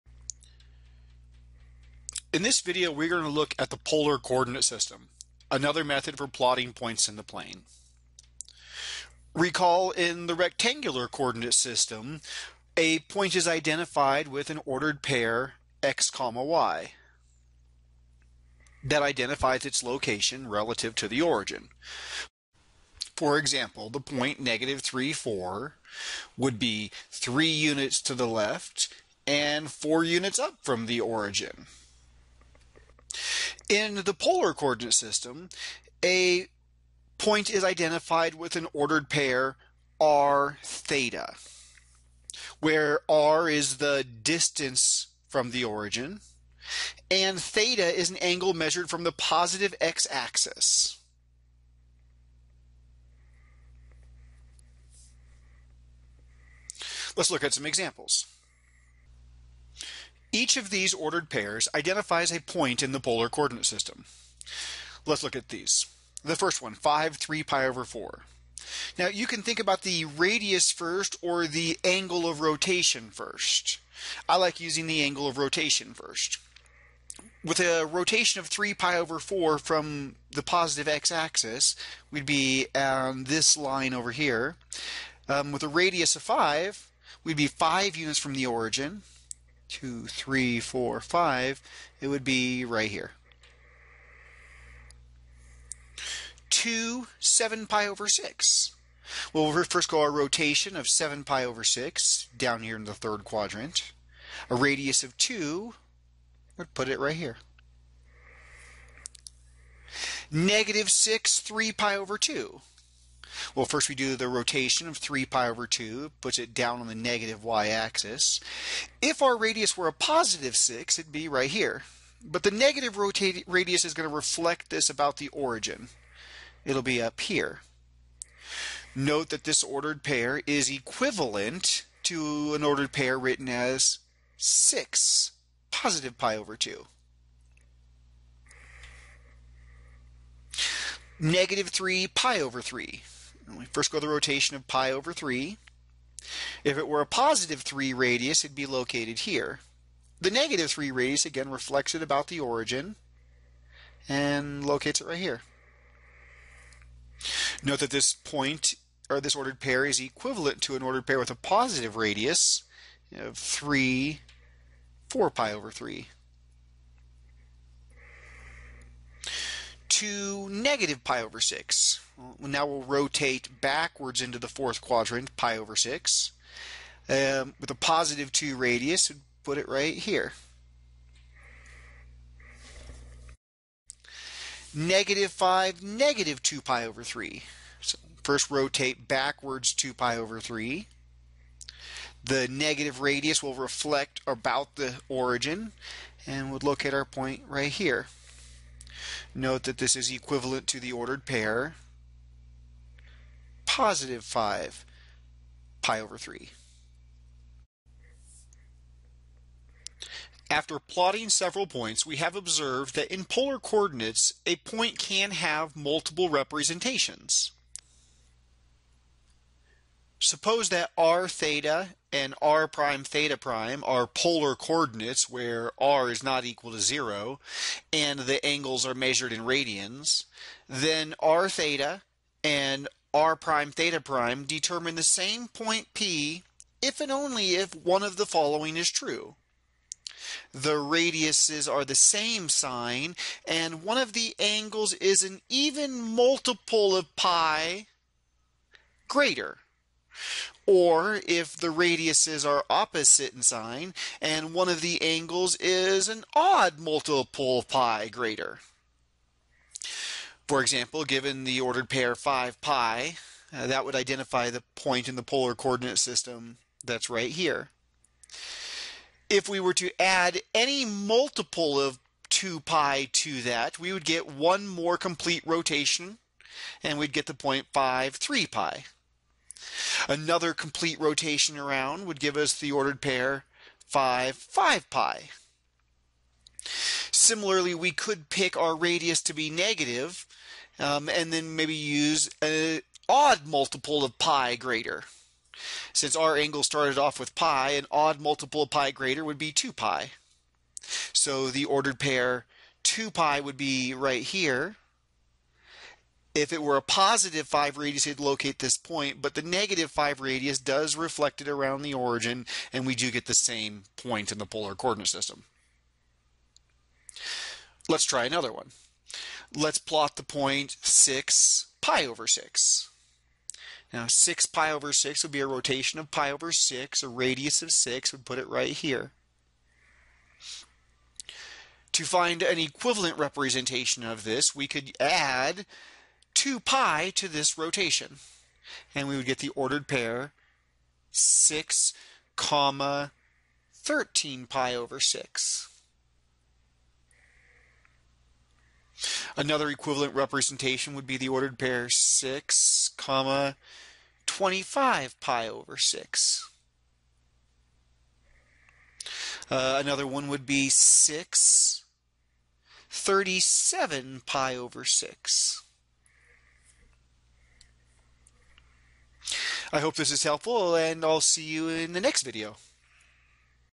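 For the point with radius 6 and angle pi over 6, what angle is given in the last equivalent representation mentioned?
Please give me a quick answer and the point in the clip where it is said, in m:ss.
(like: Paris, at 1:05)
37 pi over 6, at 6:02.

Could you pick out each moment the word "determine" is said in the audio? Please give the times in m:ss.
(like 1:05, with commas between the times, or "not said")
3:54.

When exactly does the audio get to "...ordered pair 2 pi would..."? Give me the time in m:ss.
5:01.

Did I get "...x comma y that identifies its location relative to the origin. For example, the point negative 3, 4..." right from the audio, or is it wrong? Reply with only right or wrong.
right.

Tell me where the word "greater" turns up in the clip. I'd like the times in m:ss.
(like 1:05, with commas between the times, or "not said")
4:09, 4:18, 4:54, 4:58.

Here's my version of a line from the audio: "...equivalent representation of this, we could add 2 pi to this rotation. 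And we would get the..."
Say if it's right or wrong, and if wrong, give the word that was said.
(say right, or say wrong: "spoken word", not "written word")
right.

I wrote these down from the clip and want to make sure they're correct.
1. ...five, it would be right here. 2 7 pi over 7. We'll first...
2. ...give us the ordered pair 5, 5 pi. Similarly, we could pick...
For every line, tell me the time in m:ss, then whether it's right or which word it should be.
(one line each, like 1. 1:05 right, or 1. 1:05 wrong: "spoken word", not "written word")
1. 1:30 wrong: "6", not "7"
2. 4:42 right.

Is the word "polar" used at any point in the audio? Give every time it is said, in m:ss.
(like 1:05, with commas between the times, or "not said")
0:03, 0:34, 1:03, 3:33, 3:44, 4:25, 5:14.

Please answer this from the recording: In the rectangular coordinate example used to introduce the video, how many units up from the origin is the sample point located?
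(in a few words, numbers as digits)
4.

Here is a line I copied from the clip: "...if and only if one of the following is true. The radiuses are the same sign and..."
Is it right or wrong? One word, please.
right.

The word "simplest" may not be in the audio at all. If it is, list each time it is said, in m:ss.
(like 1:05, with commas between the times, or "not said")
not said.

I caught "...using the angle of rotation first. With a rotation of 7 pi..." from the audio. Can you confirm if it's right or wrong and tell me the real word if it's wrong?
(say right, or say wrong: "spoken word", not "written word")
wrong: "3", not "7".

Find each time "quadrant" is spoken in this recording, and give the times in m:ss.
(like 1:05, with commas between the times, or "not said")
1:43, 2:54.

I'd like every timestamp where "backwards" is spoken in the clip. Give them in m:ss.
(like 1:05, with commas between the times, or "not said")
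2:53, 3:09.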